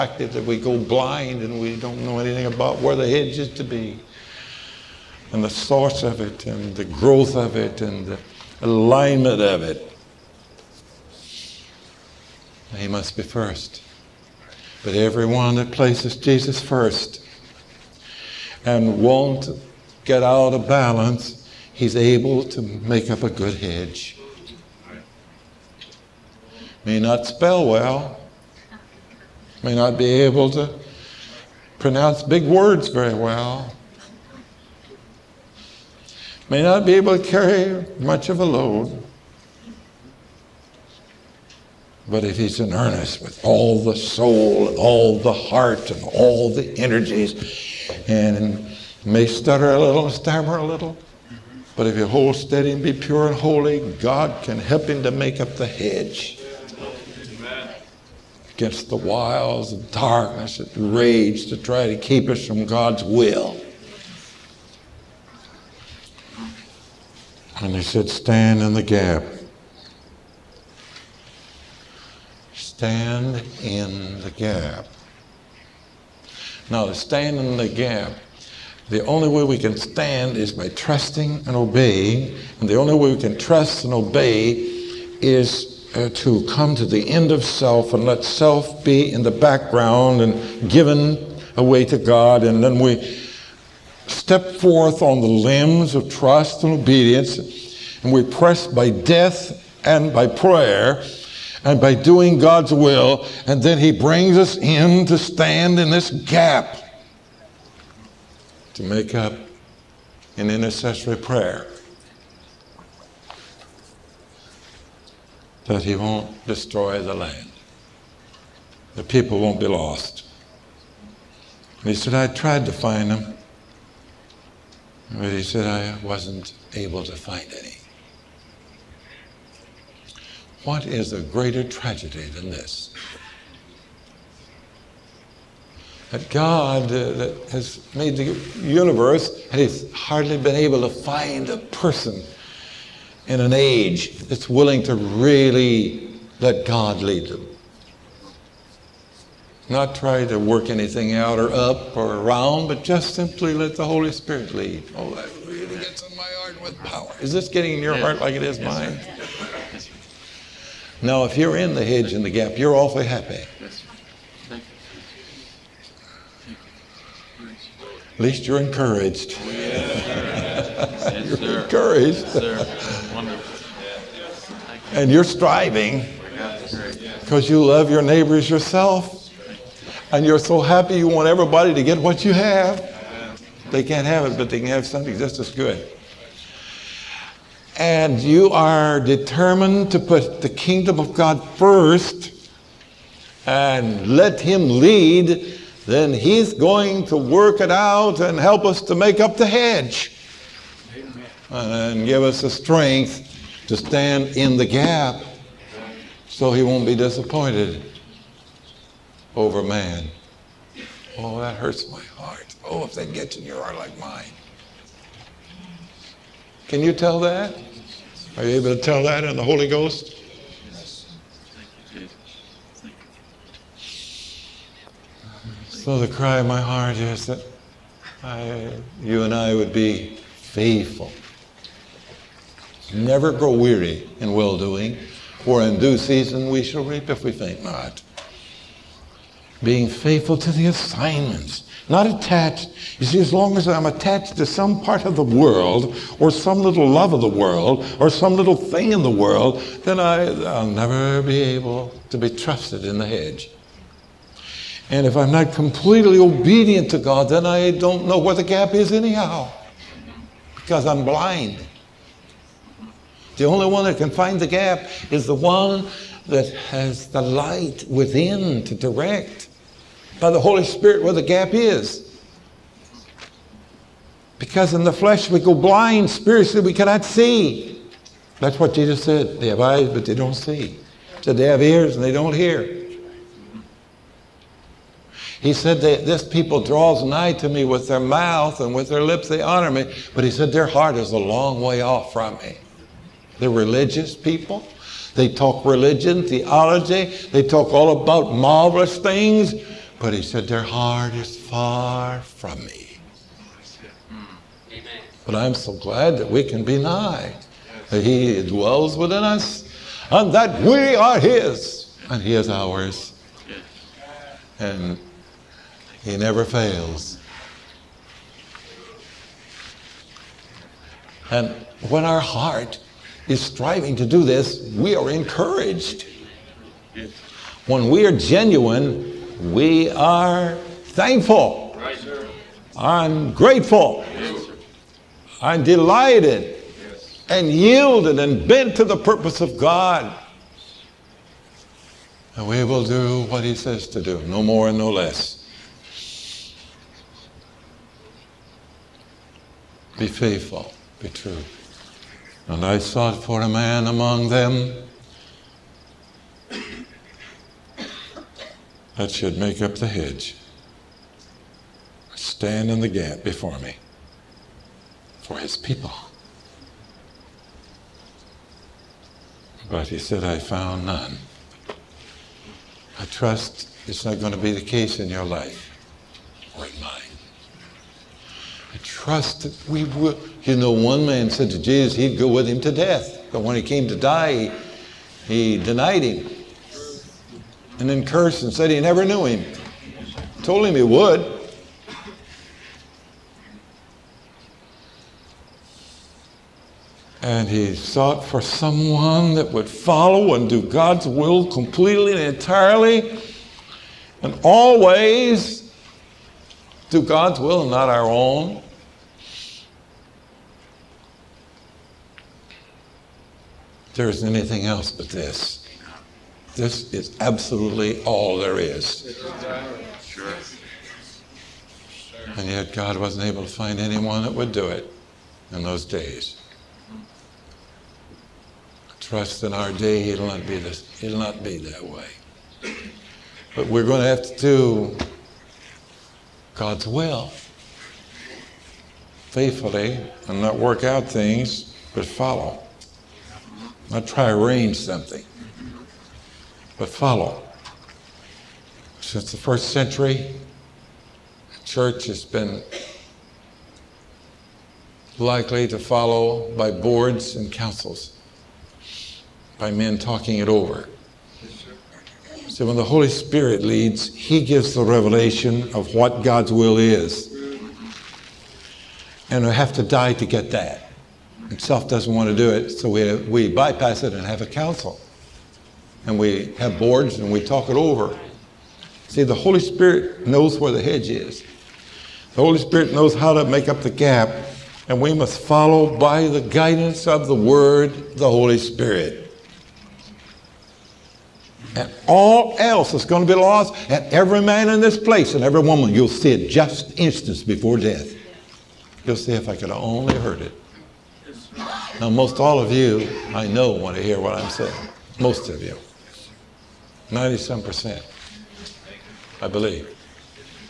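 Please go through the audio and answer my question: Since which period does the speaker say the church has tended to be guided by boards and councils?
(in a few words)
the first century.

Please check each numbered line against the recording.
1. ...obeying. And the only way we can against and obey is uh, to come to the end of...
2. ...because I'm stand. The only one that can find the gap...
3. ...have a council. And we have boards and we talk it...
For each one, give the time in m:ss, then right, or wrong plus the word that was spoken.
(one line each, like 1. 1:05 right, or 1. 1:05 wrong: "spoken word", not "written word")
1. 1:21 wrong: "trust", not "against"
2. 4:20 wrong: "blind", not "stand"
3. 7:54 right.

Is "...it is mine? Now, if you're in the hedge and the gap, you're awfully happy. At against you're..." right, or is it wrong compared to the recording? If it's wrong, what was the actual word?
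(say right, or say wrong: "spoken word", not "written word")
wrong: "least", not "against".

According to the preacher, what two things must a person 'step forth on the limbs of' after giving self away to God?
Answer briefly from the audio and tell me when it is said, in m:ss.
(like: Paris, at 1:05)
trust and obedience, at 1:36.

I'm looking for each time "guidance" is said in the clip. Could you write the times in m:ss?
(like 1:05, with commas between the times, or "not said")
8:06.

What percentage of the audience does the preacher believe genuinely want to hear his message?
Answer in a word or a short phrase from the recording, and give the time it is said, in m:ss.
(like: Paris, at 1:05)
97 percent, at 8:27.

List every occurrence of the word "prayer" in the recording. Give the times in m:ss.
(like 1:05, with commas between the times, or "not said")
1:40, 1:51.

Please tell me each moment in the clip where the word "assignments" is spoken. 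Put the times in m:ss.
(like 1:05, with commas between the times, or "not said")
4:00.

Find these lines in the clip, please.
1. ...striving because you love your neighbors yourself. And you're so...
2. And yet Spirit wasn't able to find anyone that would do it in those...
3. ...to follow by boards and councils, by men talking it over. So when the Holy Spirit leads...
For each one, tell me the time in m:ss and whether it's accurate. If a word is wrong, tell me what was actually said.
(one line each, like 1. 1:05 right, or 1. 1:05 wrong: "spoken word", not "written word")
1. 2:55 right
2. 7:02 wrong: "God", not "Spirit"
3. 7:35 right.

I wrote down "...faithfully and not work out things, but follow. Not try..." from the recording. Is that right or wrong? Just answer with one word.
right.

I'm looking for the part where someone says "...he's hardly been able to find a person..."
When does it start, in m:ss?
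2:19.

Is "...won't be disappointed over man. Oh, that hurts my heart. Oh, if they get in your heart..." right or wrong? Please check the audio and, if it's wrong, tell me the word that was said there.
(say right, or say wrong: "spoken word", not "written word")
right.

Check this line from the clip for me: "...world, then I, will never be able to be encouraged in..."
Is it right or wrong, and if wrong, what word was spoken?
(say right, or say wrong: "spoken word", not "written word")
wrong: "trusted", not "encouraged".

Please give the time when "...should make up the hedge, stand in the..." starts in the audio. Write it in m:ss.
5:59.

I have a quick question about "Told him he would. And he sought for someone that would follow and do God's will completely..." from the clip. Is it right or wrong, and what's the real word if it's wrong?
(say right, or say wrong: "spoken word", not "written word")
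right.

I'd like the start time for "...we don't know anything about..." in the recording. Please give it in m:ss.
0:01.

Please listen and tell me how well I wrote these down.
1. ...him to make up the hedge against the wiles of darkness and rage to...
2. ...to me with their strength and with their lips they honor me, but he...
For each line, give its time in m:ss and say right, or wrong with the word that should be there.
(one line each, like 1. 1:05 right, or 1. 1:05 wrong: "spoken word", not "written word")
1. 0:54 right
2. 4:47 wrong: "mouth", not "strength".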